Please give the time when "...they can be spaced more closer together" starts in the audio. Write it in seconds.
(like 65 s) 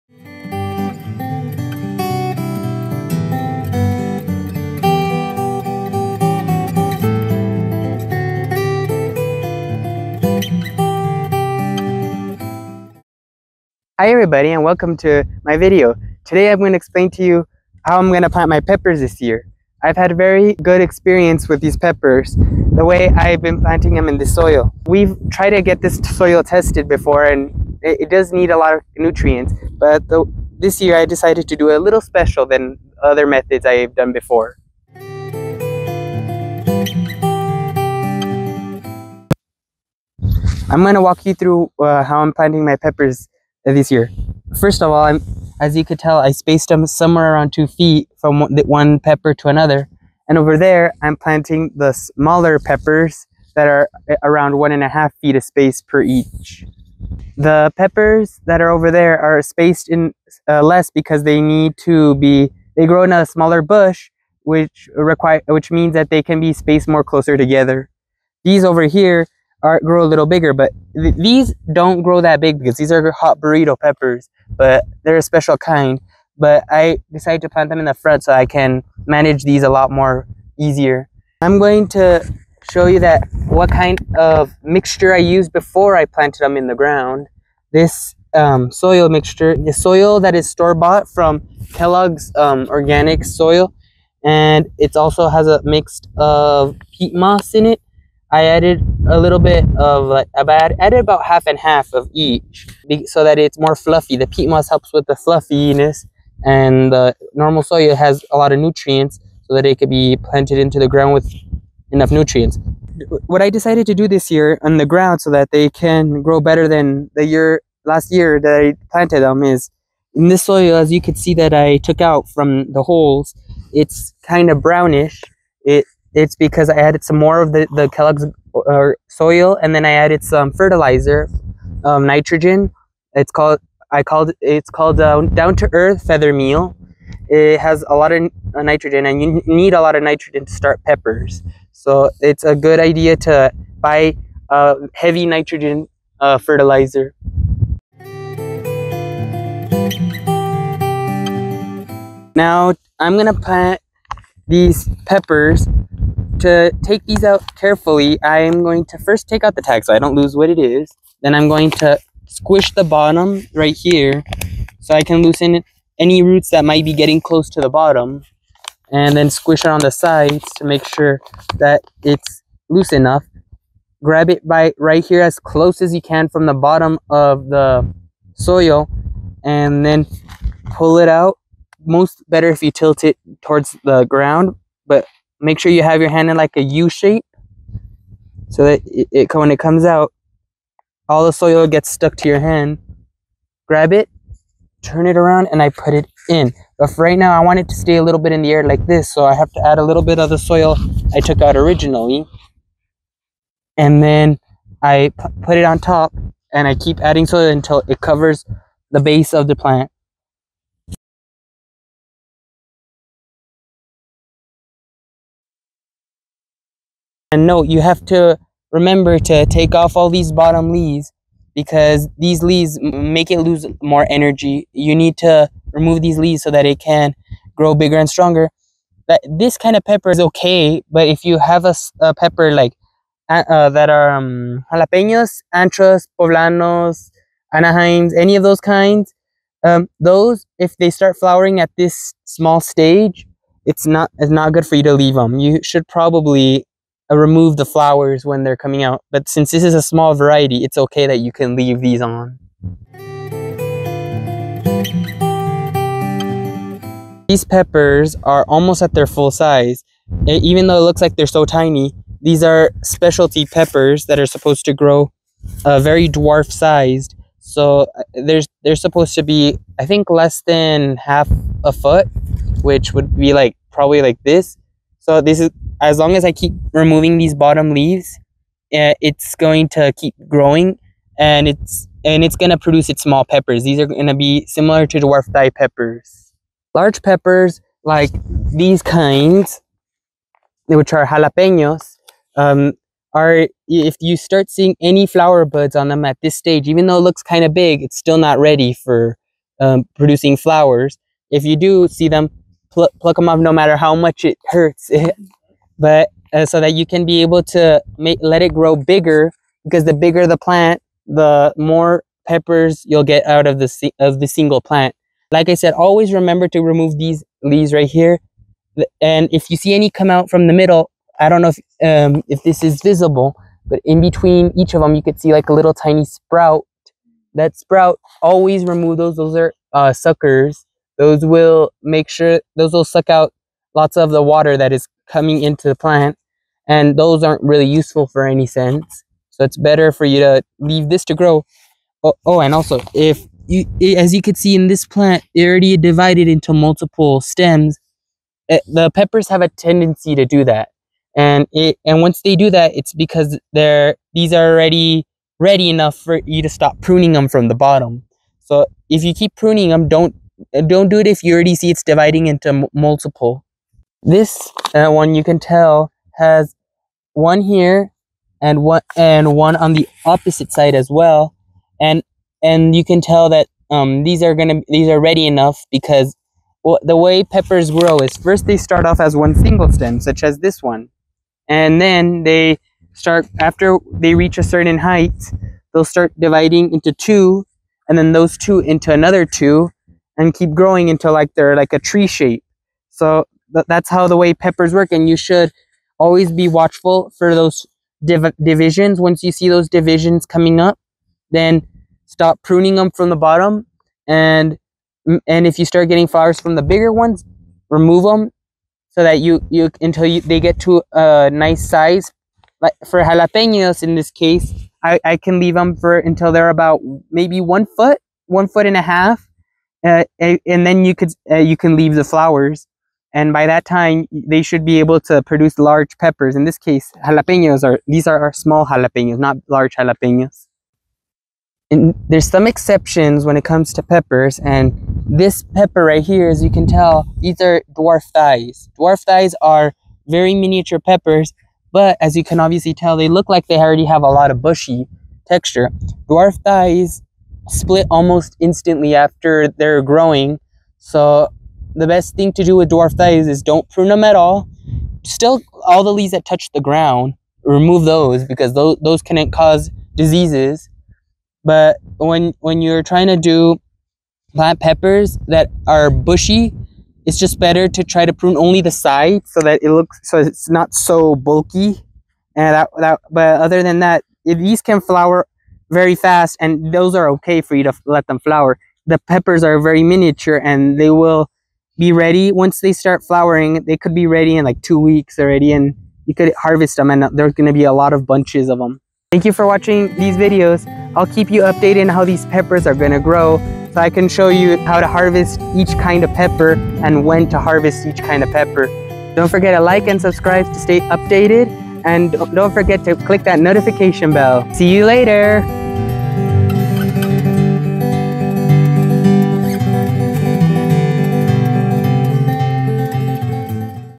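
66 s.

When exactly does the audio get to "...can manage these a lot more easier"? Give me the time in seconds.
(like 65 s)
78 s.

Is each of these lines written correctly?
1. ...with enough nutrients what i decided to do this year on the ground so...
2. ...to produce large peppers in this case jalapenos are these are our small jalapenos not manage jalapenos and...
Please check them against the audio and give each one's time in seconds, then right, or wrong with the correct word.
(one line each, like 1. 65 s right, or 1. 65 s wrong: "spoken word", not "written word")
1. 111 s right
2. 425 s wrong: "large", not "manage".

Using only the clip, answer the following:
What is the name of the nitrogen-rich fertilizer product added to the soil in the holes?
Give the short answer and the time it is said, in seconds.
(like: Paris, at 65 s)
Down to Earth feather meal, at 135 s.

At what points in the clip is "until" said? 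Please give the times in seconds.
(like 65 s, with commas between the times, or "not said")
207 s, 390 s, 409 s, 415 s.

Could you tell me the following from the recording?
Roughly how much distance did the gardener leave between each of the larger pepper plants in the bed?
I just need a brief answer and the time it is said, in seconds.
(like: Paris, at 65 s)
2 feet, at 47 s.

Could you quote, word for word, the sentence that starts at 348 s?
It, eh, the peppers have a tendency to do that.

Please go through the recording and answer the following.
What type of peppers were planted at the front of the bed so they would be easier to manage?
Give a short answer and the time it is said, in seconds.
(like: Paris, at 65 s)
Hot burrito peppers, at 73 s.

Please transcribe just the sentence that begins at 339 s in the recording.
So it's better for you to leave this to grow.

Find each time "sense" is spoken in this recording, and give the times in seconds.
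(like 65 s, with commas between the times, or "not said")
338 s.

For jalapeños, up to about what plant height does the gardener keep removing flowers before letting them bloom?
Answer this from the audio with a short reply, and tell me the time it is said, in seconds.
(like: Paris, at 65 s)
1.5 feet, at 418 s.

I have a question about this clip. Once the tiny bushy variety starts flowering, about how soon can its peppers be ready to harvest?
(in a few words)
2 weeks.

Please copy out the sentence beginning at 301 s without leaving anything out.
If you do see them, pl pluck them off no matter how much it hurts.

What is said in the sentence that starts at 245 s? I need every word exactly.
You should probably uh, remove the flowers when they're coming out.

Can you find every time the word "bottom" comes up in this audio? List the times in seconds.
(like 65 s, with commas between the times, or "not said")
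162 s, 167 s, 176 s, 220 s, 277 s, 357 s, 403 s.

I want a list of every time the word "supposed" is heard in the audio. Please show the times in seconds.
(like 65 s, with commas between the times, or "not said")
264 s, 268 s.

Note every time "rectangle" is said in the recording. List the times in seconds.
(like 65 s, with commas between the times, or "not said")
not said.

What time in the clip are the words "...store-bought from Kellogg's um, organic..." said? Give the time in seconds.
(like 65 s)
90 s.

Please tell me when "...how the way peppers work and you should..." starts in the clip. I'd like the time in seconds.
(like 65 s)
393 s.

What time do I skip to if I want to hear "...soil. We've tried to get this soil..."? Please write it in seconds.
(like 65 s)
24 s.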